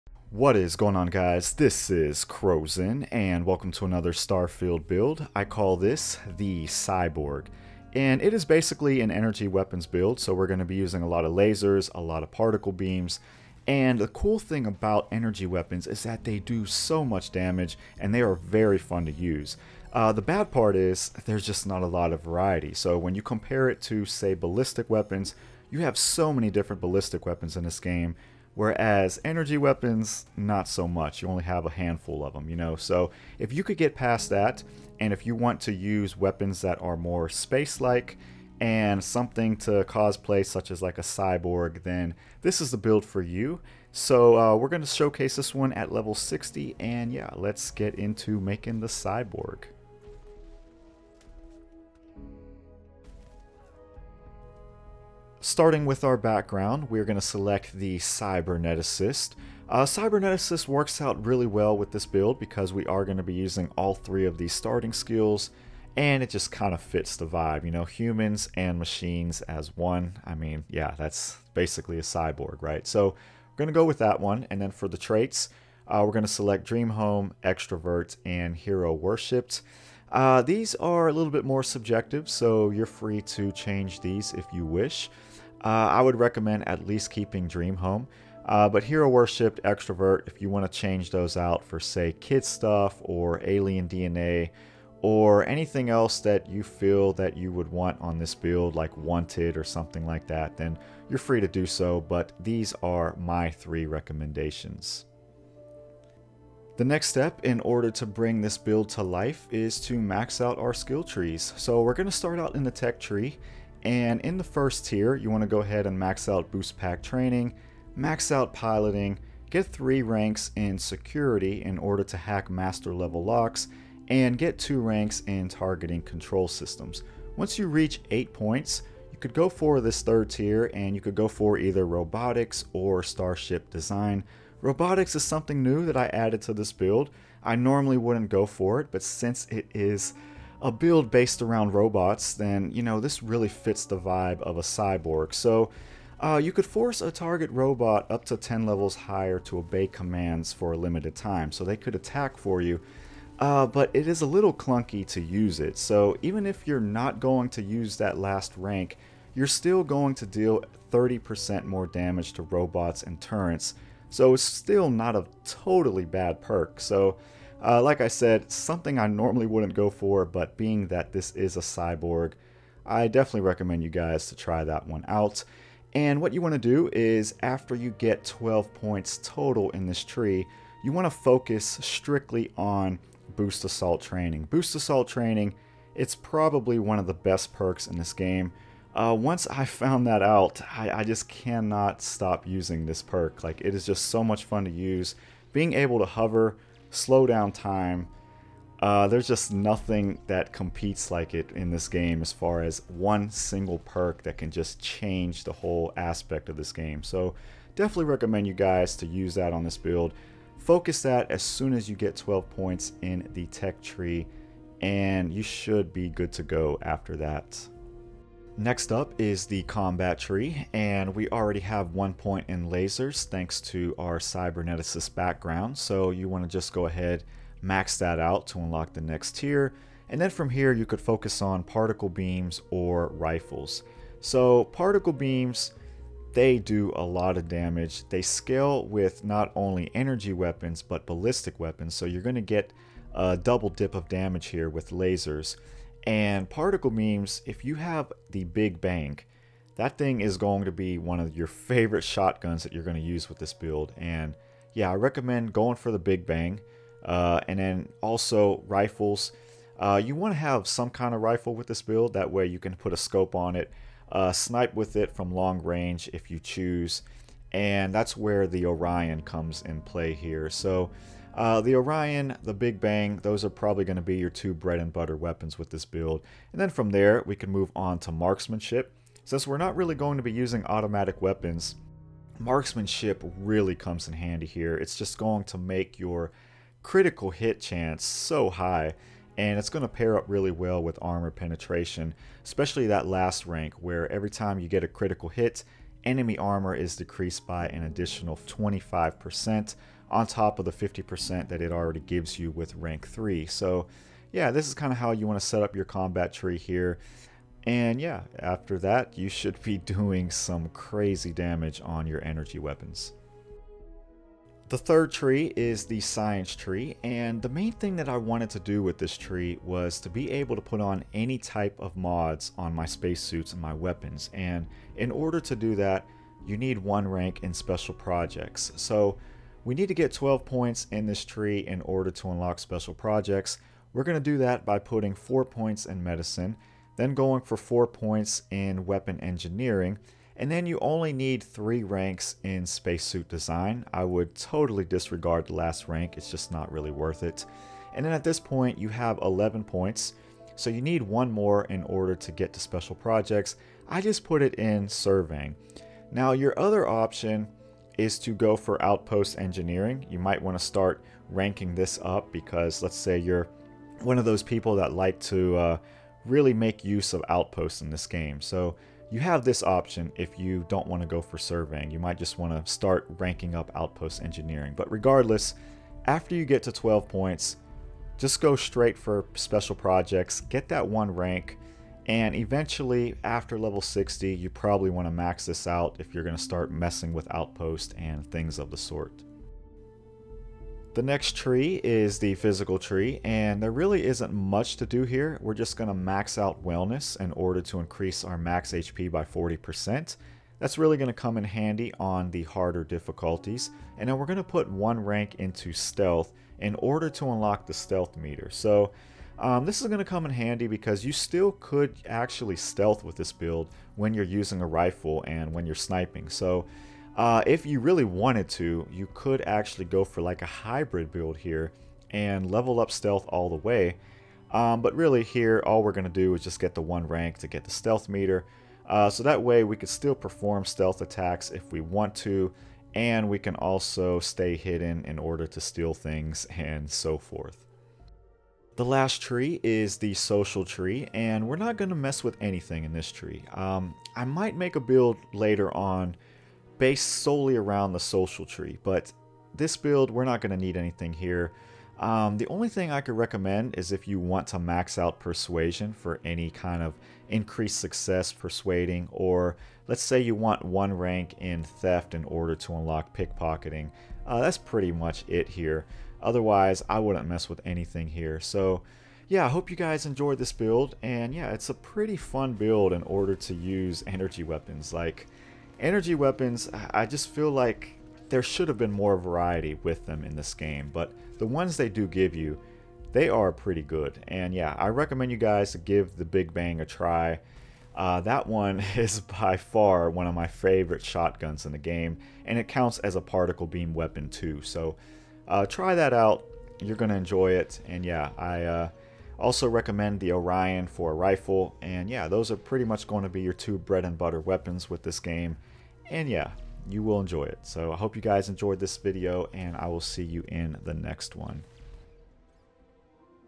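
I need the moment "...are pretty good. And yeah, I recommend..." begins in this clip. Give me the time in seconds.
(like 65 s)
483 s.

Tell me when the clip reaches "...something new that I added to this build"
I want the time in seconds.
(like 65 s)
135 s.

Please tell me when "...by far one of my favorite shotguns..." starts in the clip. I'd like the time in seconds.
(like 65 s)
489 s.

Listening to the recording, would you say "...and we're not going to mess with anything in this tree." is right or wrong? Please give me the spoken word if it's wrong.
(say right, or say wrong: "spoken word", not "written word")
right.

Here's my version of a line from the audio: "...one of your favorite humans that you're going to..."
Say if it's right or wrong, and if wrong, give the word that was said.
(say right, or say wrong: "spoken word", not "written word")
wrong: "shotguns", not "humans".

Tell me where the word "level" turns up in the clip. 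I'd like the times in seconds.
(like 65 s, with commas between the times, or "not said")
45 s, 122 s, 148 s, 383 s, 422 s.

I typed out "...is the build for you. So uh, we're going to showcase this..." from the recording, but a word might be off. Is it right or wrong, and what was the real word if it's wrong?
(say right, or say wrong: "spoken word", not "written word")
right.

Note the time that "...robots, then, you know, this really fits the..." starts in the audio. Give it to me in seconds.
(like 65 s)
141 s.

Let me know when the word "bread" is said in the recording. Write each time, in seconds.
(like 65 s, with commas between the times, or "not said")
274 s, 503 s.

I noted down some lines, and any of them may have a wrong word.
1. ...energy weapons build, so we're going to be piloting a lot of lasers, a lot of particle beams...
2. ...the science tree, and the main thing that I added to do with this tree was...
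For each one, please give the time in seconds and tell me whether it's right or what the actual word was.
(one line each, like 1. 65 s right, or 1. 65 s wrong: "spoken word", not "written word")
1. 9 s wrong: "using", not "piloting"
2. 315 s wrong: "wanted", not "added".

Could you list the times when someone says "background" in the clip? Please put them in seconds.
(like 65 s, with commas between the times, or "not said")
56 s, 225 s.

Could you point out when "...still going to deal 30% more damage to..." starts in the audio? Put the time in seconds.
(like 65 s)
159 s.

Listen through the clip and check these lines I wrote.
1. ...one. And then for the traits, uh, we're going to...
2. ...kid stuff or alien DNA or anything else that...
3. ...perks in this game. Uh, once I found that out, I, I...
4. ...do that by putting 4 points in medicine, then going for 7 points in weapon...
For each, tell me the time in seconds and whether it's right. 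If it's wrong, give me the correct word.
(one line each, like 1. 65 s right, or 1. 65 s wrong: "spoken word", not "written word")
1. 74 s right
2. 92 s right
3. 187 s right
4. 334 s wrong: "4", not "7".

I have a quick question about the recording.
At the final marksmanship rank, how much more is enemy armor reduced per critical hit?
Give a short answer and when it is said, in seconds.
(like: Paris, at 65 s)
25%, at 298 s.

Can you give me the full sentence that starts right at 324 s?
And in order to do that, you need one rank in special projects.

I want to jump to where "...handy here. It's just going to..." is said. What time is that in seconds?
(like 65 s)
284 s.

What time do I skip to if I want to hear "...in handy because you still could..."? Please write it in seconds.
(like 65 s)
410 s.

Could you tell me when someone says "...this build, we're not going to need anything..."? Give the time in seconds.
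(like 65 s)
449 s.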